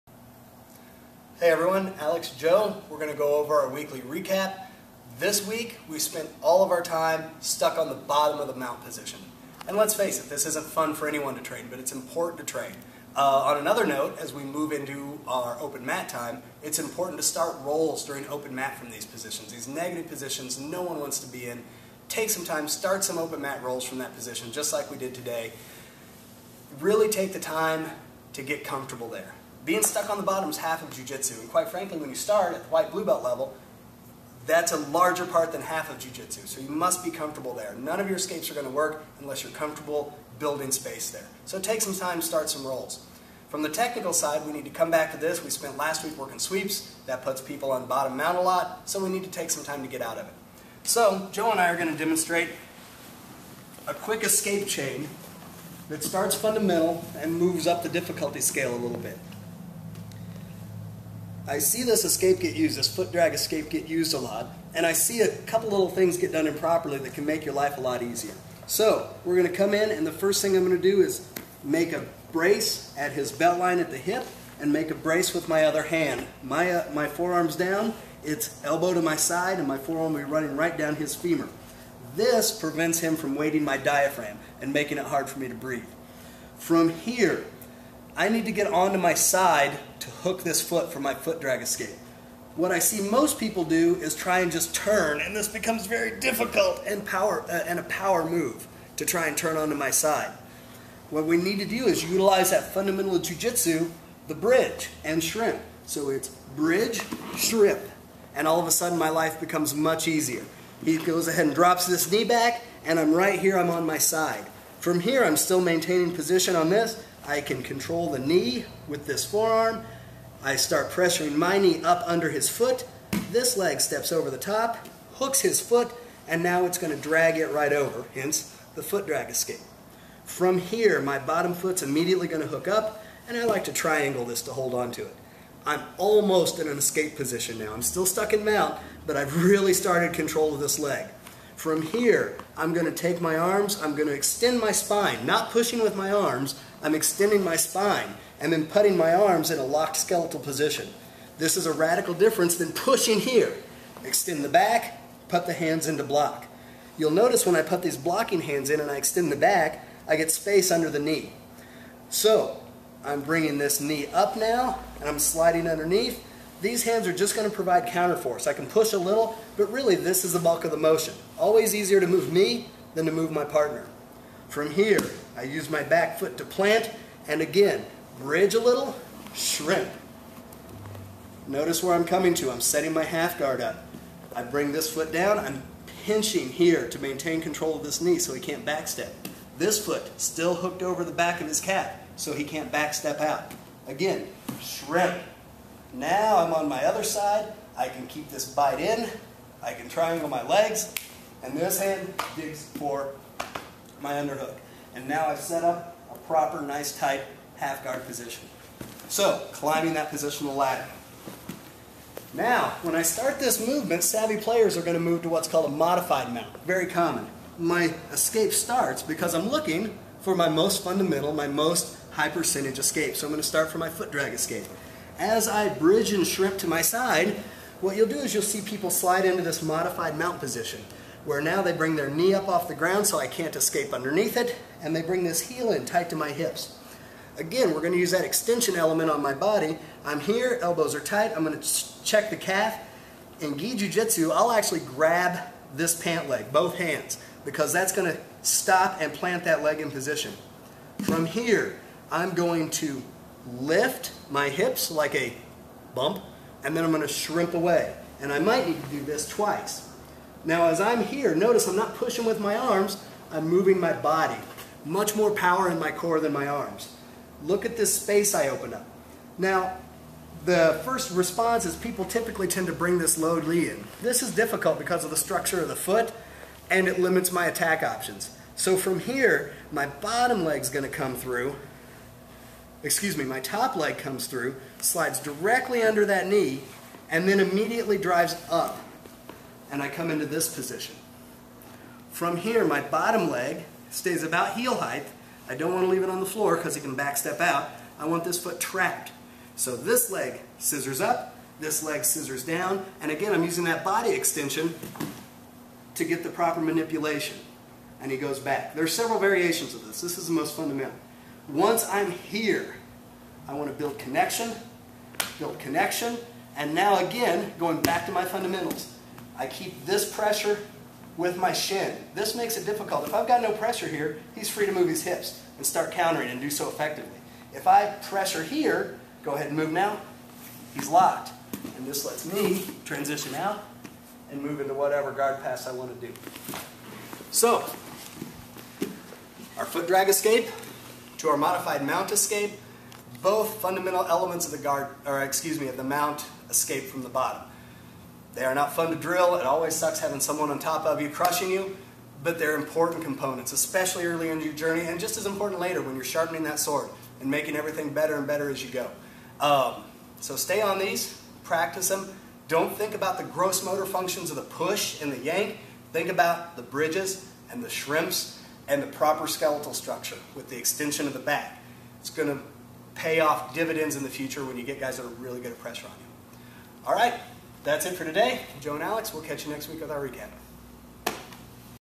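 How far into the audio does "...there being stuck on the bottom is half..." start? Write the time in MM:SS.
00:29.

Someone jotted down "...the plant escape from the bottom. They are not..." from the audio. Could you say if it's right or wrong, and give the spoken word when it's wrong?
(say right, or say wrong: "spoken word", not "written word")
wrong: "mount", not "plant".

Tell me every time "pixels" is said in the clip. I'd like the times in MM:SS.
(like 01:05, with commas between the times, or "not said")
not said.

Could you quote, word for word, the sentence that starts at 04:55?
I don't want to leave it on the floor because it can backstep out.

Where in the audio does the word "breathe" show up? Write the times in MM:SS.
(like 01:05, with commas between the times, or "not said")
01:25.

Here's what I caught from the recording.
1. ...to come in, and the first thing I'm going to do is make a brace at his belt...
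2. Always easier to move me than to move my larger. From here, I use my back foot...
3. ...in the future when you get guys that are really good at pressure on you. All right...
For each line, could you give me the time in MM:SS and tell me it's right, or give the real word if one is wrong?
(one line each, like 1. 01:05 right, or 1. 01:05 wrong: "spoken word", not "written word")
1. 01:09 right
2. 02:51 wrong: "partner", not "larger"
3. 06:13 right.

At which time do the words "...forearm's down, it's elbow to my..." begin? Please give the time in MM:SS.
01:17.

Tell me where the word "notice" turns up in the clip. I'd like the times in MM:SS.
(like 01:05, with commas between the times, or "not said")
02:37, 03:01, 04:21.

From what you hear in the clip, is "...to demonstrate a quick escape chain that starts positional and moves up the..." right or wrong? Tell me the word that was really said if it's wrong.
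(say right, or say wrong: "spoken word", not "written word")
wrong: "fundamental", not "positional".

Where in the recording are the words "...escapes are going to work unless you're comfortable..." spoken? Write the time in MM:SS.
00:38.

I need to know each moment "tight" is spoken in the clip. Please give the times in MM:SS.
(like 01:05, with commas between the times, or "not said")
03:26, 03:55, 04:00.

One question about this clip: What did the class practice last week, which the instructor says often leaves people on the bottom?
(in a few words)
Sweeps.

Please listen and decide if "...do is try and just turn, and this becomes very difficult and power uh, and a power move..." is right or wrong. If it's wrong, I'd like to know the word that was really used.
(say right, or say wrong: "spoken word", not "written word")
right.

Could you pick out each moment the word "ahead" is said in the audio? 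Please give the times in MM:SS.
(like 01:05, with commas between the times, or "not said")
01:51, 05:29.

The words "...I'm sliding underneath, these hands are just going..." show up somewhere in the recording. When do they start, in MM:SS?
02:45.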